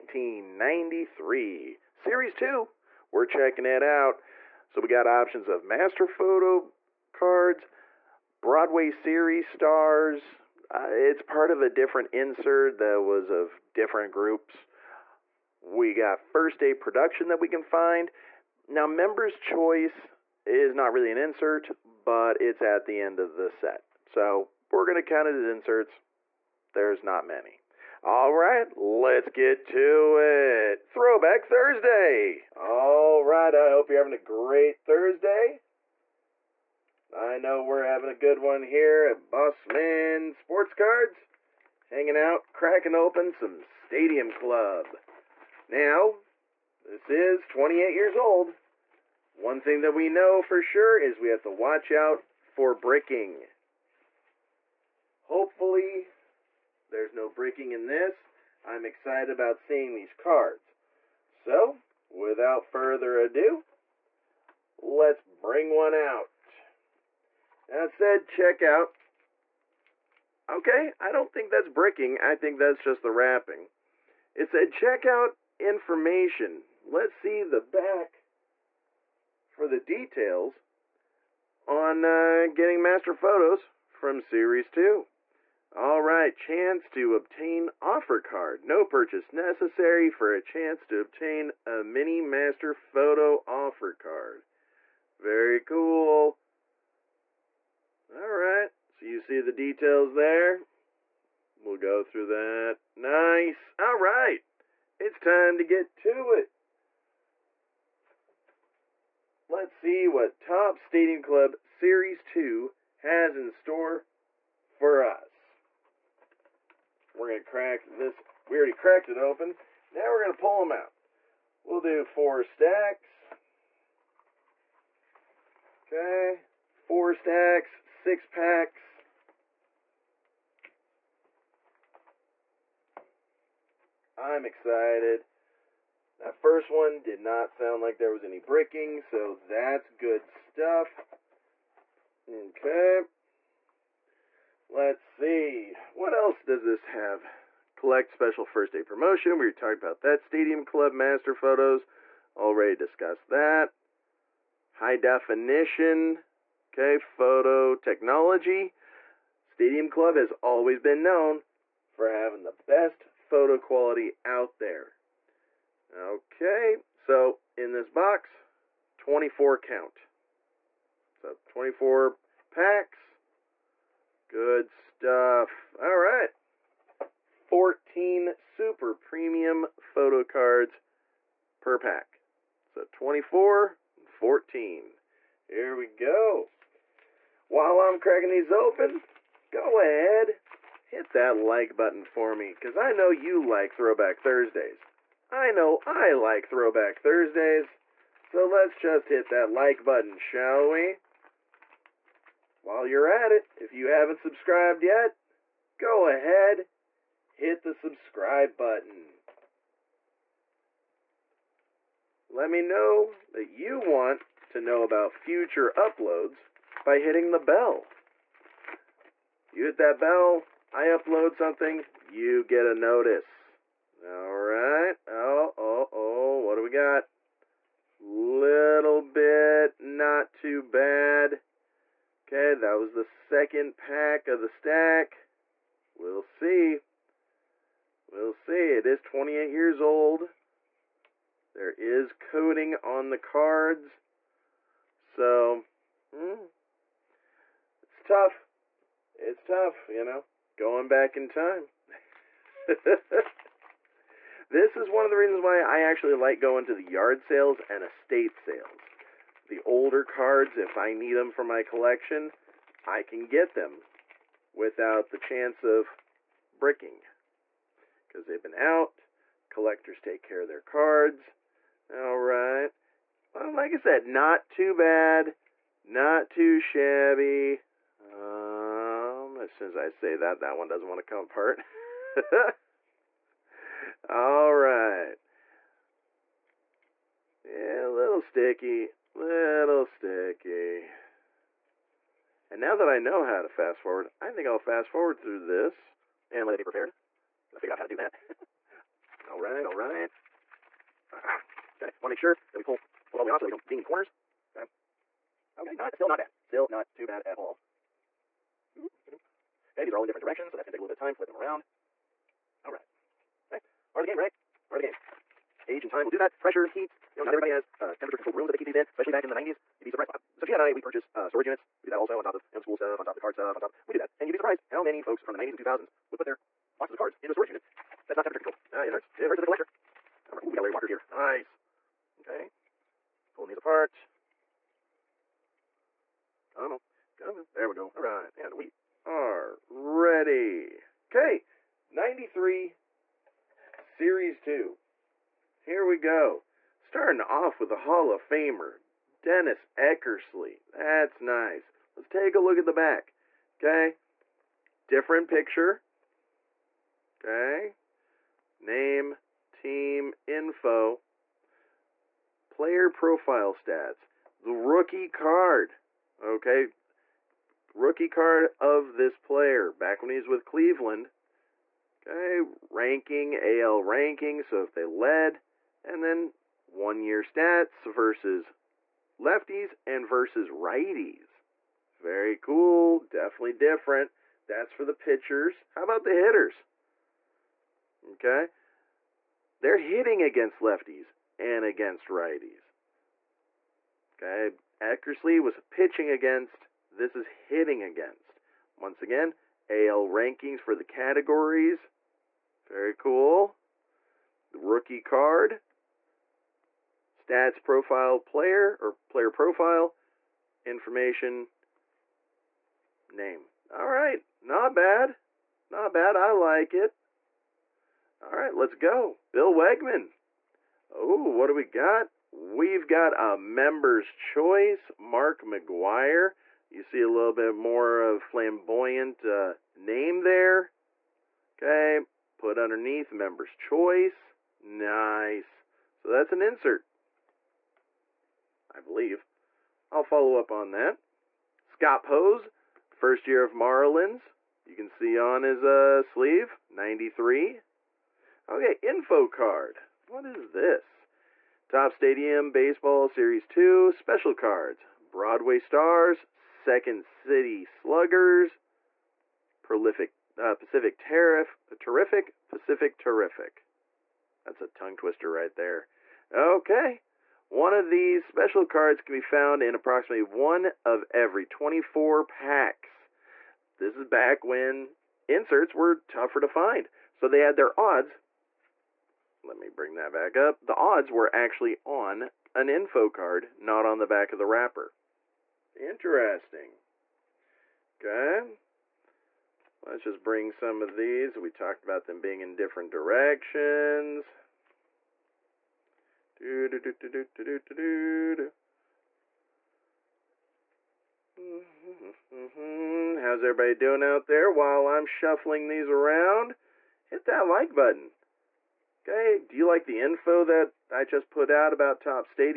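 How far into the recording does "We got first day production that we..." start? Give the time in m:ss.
0:15.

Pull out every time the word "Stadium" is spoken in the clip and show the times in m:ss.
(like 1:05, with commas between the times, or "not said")
0:43, 1:50, 2:30, 2:39, 7:31.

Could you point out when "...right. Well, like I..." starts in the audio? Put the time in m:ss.
4:32.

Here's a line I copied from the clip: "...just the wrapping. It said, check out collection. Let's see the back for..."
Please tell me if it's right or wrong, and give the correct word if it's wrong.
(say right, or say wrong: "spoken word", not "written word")
wrong: "information", not "collection".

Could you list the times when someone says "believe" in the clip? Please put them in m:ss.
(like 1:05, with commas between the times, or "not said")
7:18.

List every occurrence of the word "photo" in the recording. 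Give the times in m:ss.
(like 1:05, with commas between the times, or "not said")
0:06, 1:23, 1:32, 2:31, 2:36, 2:43, 2:59.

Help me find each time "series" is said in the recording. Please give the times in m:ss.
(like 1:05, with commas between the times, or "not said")
0:01, 0:08, 1:24, 1:51, 5:43, 7:33.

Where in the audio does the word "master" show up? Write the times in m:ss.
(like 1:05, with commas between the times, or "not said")
0:05, 1:22, 1:32, 2:30.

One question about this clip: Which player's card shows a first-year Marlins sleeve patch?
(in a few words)
Scott Pose.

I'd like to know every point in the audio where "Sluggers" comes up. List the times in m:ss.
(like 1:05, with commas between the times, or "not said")
7:37.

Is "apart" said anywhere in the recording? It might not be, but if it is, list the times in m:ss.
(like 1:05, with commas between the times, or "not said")
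4:41, 5:33.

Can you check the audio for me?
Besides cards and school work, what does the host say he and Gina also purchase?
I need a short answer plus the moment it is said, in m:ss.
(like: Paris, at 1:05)
storage units, at 5:21.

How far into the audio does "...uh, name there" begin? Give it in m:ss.
7:09.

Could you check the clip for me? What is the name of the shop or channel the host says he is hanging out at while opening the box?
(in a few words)
Bossman Sports Cards.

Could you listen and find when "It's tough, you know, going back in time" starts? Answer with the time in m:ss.
4:09.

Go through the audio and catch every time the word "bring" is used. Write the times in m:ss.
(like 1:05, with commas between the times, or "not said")
1:05, 7:59, 8:10.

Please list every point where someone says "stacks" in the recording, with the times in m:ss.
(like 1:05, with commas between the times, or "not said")
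2:02, 2:07, 3:54.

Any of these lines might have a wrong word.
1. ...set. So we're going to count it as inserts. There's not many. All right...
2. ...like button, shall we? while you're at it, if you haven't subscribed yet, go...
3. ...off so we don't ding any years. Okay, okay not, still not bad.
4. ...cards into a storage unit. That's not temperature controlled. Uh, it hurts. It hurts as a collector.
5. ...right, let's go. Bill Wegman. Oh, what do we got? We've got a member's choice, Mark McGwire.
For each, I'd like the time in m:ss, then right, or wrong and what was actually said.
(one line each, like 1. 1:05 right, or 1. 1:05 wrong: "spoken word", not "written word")
1. 0:23 right
2. 3:19 right
3. 5:03 wrong: "corners", not "years"
4. 5:26 right
5. 6:58 right.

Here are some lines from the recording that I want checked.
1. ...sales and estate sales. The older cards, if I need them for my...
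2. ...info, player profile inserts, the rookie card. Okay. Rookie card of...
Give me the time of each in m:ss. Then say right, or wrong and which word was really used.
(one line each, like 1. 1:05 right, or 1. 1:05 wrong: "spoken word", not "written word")
1. 4:17 right
2. 6:00 wrong: "stats", not "inserts".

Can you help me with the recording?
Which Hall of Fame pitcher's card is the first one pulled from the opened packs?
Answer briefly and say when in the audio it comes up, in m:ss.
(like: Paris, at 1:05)
Dennis Eckersley, at 5:49.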